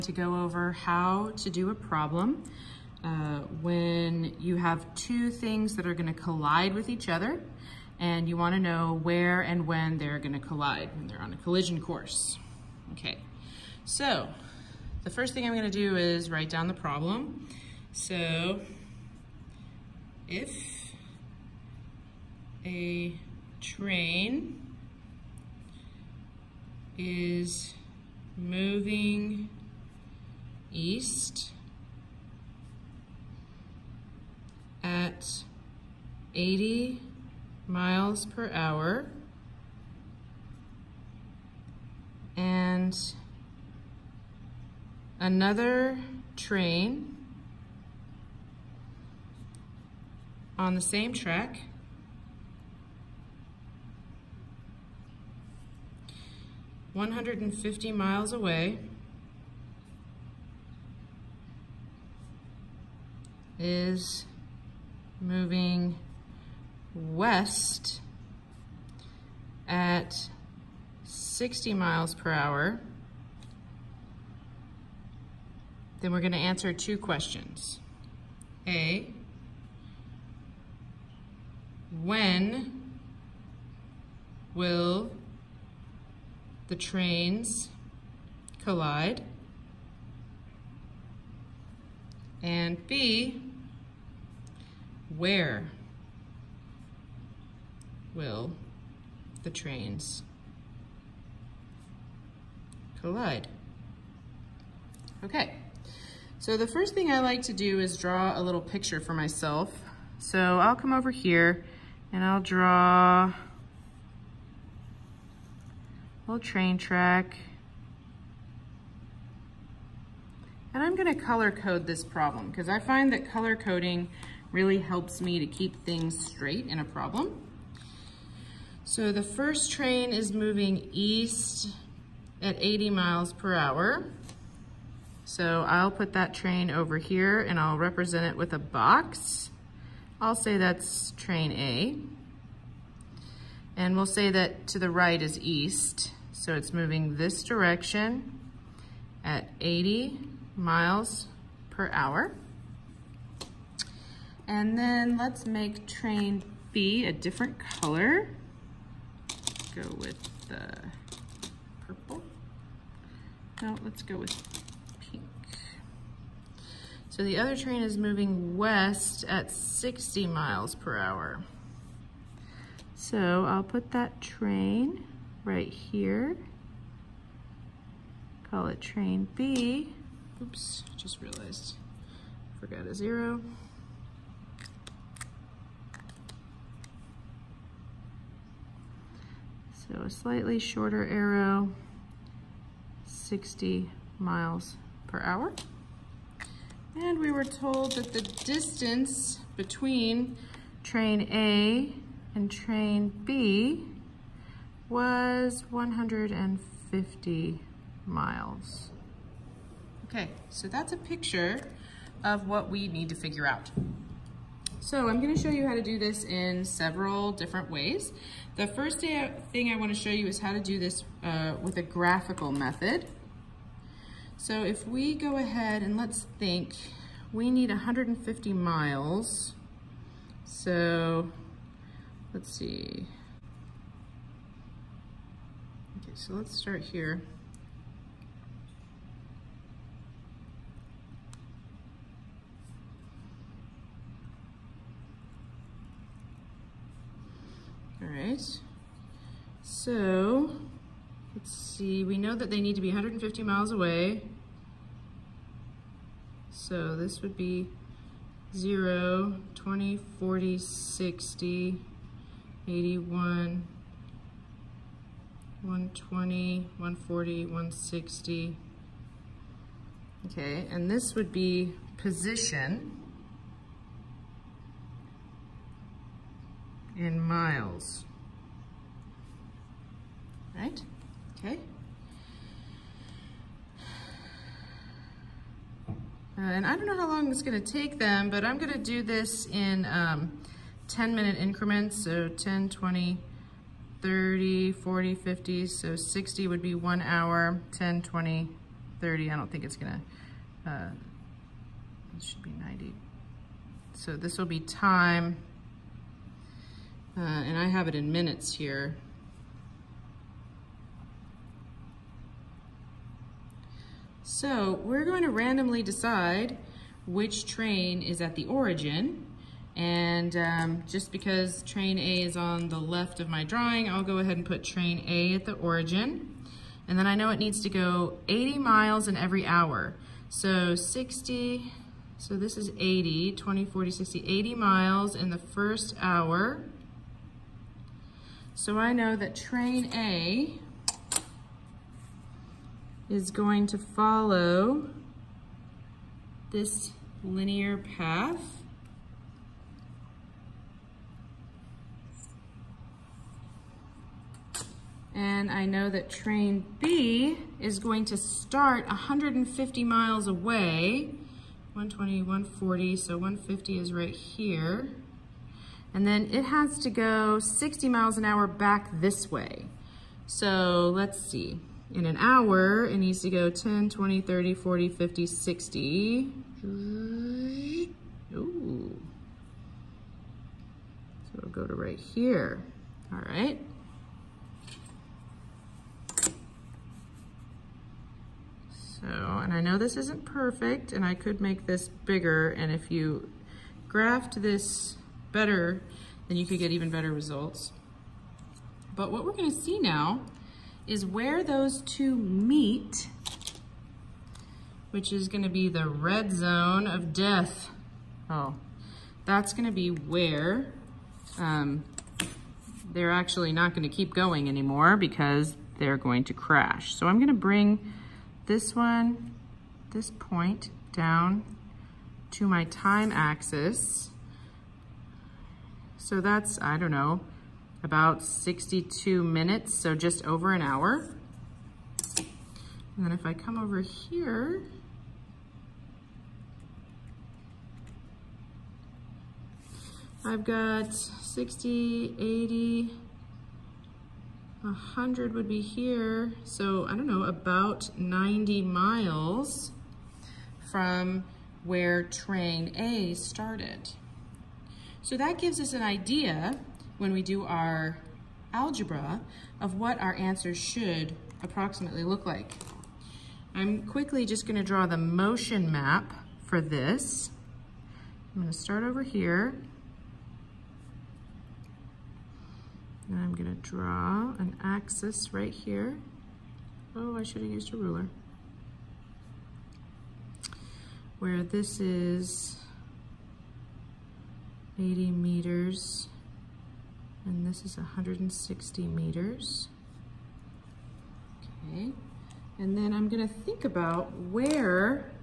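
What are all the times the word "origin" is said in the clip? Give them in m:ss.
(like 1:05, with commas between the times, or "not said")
5:18, 5:25.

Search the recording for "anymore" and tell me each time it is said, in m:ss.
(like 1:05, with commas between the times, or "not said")
6:54.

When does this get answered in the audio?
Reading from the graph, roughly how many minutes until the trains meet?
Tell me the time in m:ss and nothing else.
7:08.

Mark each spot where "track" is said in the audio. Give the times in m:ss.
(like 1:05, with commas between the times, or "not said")
0:51, 1:56.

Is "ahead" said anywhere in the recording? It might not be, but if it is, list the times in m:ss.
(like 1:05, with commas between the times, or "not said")
3:45, 5:24.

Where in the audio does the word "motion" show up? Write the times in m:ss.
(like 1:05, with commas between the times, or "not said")
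7:44.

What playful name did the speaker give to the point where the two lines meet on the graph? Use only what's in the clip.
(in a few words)
Red zone of death.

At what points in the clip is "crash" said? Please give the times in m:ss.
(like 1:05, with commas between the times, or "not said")
6:56.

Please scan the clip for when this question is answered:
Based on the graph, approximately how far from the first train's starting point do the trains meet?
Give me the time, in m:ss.
7:27.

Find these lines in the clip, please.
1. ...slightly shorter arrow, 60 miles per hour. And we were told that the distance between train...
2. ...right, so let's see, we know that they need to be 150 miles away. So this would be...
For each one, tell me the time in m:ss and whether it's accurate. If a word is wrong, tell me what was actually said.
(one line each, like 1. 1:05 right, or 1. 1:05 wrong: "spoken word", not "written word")
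1. 3:10 right
2. 4:08 right.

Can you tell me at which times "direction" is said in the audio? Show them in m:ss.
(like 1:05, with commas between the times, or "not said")
2:27.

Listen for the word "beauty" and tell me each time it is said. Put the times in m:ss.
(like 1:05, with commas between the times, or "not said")
not said.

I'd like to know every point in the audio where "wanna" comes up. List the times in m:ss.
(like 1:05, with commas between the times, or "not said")
0:08, 3:39.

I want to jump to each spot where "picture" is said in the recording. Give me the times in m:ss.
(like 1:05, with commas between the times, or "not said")
1:48, 3:30.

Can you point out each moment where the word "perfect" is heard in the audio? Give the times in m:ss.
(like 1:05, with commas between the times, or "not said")
6:30.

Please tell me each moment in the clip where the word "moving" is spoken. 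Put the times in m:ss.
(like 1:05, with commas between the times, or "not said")
0:28, 1:05, 2:10, 2:26, 2:47.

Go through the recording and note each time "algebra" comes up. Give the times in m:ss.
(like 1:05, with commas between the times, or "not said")
7:38.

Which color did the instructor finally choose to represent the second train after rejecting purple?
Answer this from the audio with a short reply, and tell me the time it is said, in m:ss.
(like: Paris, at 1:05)
Pink, at 2:45.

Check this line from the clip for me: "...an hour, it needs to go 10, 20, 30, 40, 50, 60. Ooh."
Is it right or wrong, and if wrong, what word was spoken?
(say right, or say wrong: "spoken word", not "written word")
right.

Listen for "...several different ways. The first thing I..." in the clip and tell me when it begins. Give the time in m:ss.
3:36.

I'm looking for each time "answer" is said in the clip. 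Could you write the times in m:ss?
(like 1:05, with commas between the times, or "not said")
1:16, 7:40.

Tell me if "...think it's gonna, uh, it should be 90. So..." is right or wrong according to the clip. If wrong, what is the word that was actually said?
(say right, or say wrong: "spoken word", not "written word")
right.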